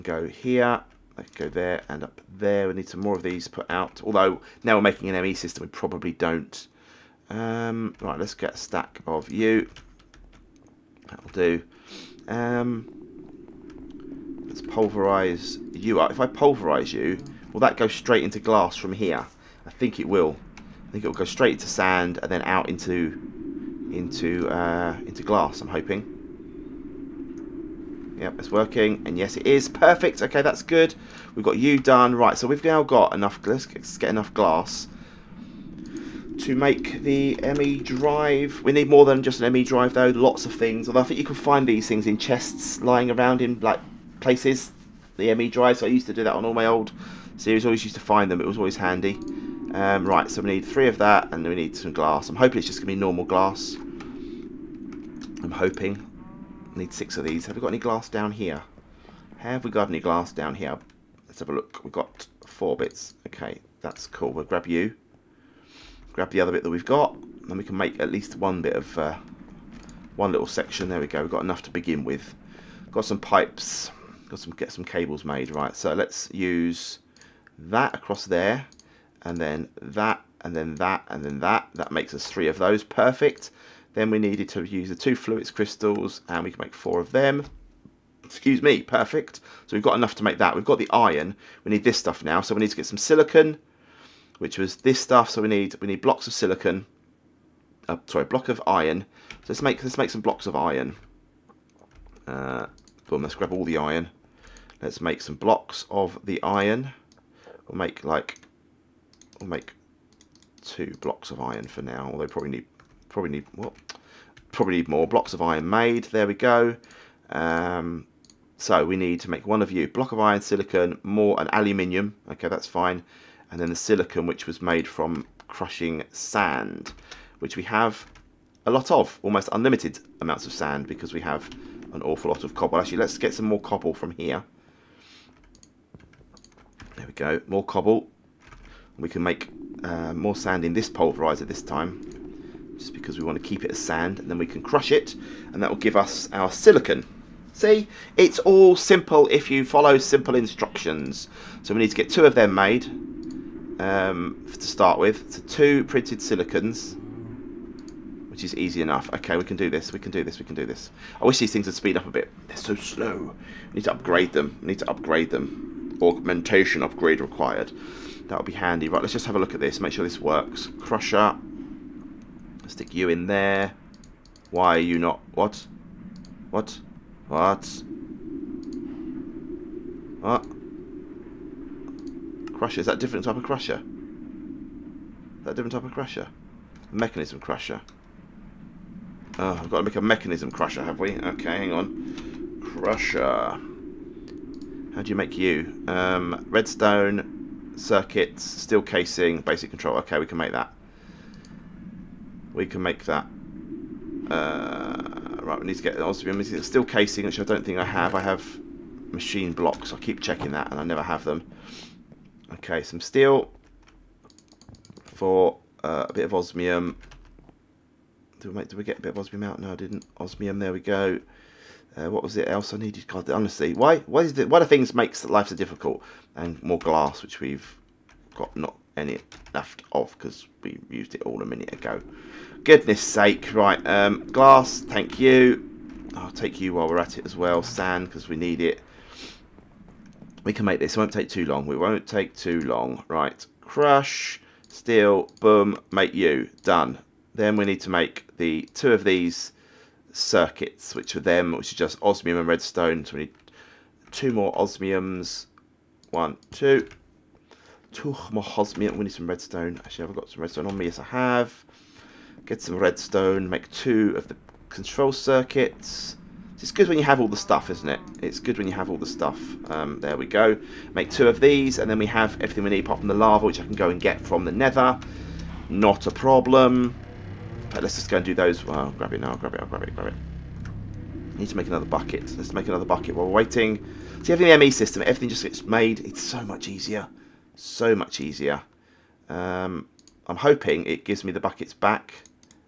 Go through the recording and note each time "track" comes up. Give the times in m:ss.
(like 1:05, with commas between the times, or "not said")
not said.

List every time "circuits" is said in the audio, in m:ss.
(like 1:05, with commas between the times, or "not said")
3:17, 4:10, 4:25.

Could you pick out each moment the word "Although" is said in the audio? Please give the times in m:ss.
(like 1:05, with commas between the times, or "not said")
0:04, 0:40, 1:52.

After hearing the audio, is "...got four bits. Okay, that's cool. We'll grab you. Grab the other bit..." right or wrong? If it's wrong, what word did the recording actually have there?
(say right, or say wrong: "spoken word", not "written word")
right.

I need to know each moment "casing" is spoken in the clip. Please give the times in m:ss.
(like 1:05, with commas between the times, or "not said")
3:18, 3:26.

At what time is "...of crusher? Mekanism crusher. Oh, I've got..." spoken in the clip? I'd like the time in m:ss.
3:05.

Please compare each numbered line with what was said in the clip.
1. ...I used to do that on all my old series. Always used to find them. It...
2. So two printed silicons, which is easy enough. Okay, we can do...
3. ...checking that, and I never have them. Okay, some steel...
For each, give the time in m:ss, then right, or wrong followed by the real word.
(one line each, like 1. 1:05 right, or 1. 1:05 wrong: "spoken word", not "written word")
1. 0:45 right
2. 2:35 right
3. 3:30 right.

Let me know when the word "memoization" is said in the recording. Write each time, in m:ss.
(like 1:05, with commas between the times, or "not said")
not said.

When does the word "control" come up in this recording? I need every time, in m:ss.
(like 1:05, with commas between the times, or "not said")
3:19, 4:24.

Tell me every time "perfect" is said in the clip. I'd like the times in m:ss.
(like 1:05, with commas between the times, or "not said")
0:29, 1:22, 1:28.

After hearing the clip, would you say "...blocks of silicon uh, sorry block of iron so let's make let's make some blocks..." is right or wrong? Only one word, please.
right.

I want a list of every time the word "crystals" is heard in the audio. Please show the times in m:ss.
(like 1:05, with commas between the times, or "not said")
1:25.